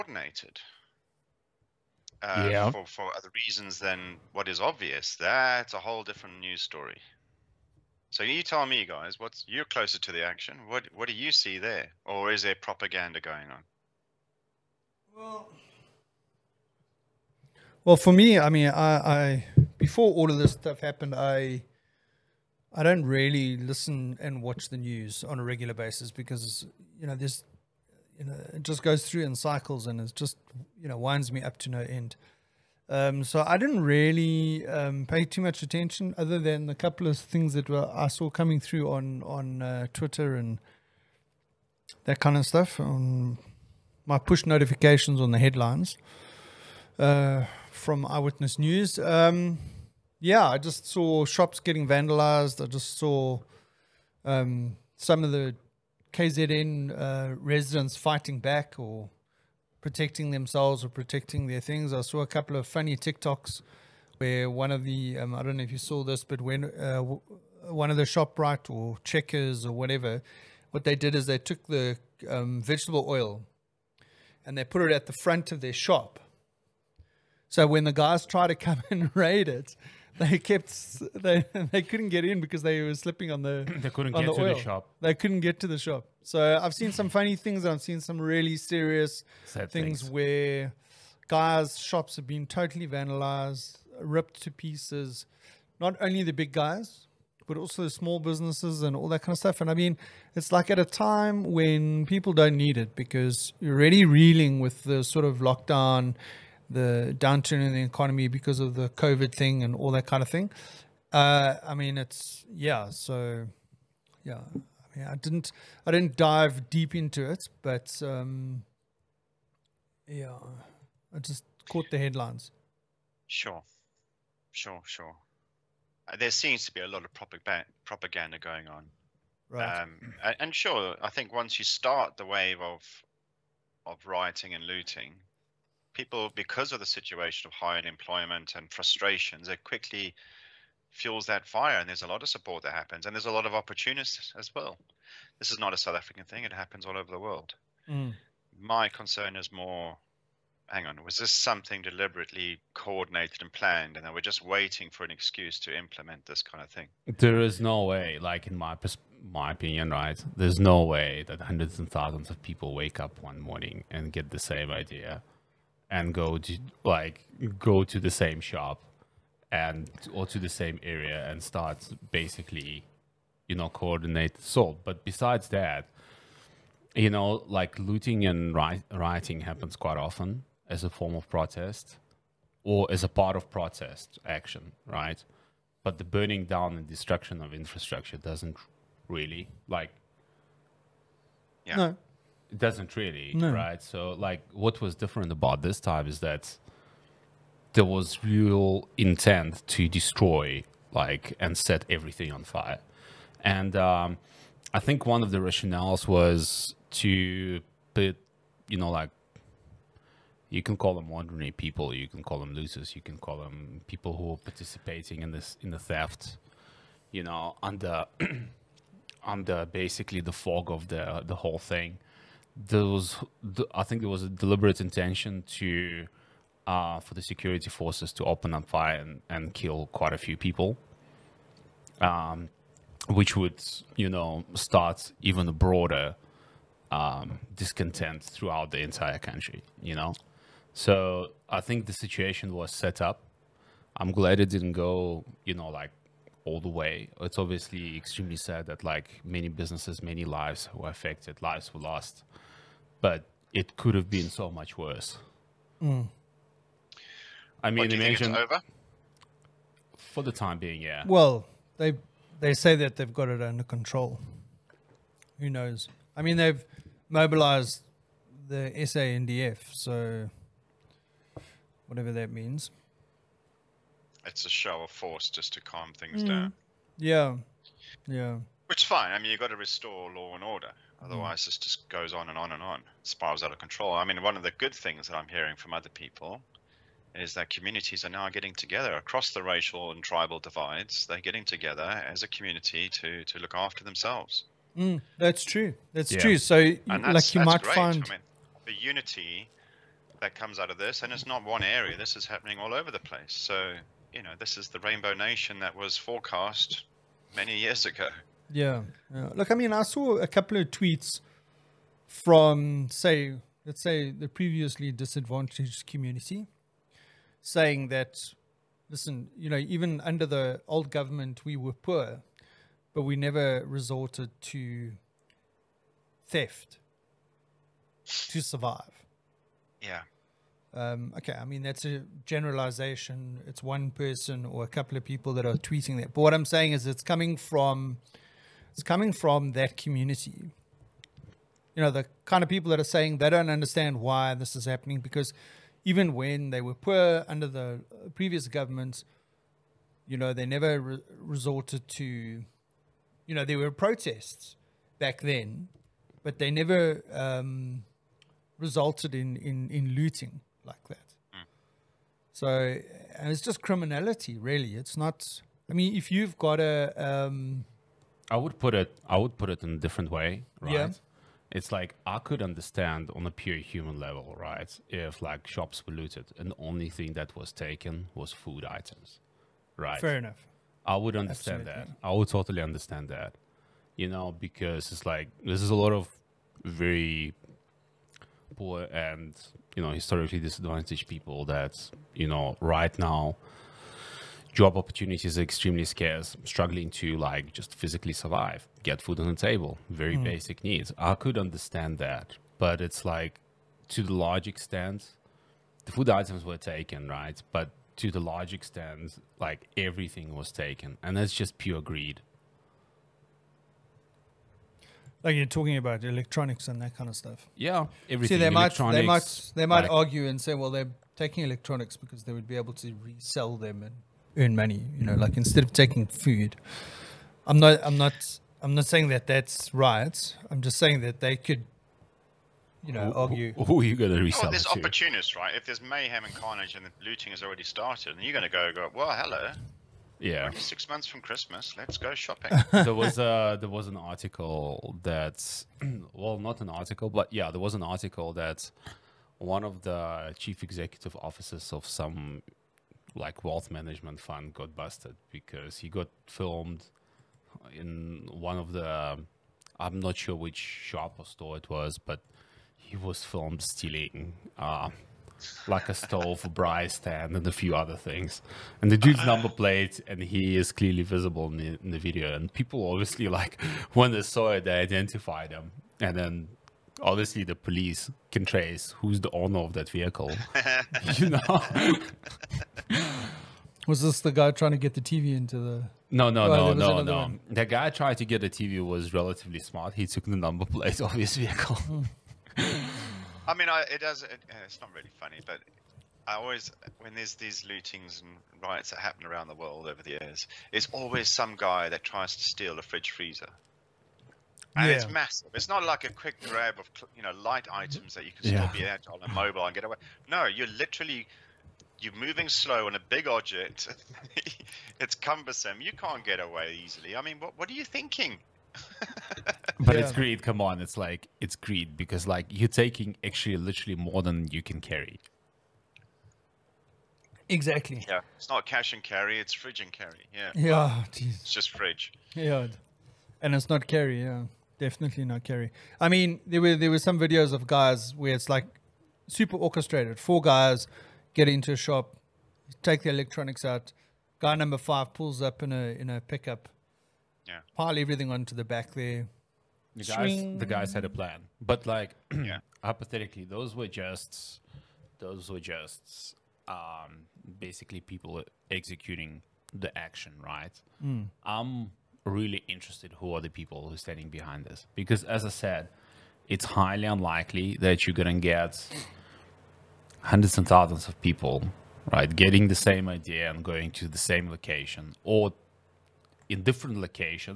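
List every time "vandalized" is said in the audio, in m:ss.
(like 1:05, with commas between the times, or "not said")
0:51, 1:32.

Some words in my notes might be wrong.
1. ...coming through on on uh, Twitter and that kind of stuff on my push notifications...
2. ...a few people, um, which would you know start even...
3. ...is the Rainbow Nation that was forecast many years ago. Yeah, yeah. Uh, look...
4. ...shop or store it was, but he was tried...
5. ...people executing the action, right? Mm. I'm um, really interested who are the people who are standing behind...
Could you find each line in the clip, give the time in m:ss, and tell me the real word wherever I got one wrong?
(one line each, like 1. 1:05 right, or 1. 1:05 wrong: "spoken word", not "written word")
1. 0:38 right
2. 3:50 right
3. 5:04 right
4. 7:40 wrong: "filmed", not "tried"
5. 9:18 right.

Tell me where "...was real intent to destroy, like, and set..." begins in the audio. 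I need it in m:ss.
3:17.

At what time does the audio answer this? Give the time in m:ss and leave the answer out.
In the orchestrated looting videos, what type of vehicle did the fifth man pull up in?
9:06.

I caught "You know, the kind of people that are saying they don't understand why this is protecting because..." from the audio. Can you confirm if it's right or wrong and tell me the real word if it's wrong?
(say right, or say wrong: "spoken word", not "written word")
wrong: "happening", not "protecting".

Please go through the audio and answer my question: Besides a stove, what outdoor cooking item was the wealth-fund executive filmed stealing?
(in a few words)
braai stand.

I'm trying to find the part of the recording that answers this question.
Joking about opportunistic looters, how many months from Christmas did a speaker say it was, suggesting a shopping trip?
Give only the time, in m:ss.
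7:20.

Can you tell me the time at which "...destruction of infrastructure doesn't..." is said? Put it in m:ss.
3:06.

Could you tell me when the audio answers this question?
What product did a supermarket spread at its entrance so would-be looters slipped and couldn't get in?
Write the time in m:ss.
1:12.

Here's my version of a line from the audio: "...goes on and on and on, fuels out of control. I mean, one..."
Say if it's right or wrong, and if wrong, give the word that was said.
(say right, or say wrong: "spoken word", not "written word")
wrong: "spirals", not "fuels".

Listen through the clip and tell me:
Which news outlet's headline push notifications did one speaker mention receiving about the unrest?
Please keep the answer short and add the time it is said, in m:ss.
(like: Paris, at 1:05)
Eyewitness News, at 0:48.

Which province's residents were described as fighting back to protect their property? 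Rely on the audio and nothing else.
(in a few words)
KZN.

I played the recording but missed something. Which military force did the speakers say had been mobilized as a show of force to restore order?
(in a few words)
SANDF.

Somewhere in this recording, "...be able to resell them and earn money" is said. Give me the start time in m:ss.
7:02.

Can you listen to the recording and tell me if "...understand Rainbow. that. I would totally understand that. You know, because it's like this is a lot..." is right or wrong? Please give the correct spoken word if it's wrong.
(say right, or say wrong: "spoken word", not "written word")
wrong: "Absolutely", not "Rainbow".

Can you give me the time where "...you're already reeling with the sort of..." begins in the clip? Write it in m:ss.
1:43.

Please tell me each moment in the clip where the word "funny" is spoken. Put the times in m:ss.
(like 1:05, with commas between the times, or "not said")
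1:02, 1:27, 8:15.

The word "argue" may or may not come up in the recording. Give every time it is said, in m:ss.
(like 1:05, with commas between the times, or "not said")
6:59, 7:13.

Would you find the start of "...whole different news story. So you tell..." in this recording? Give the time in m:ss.
0:05.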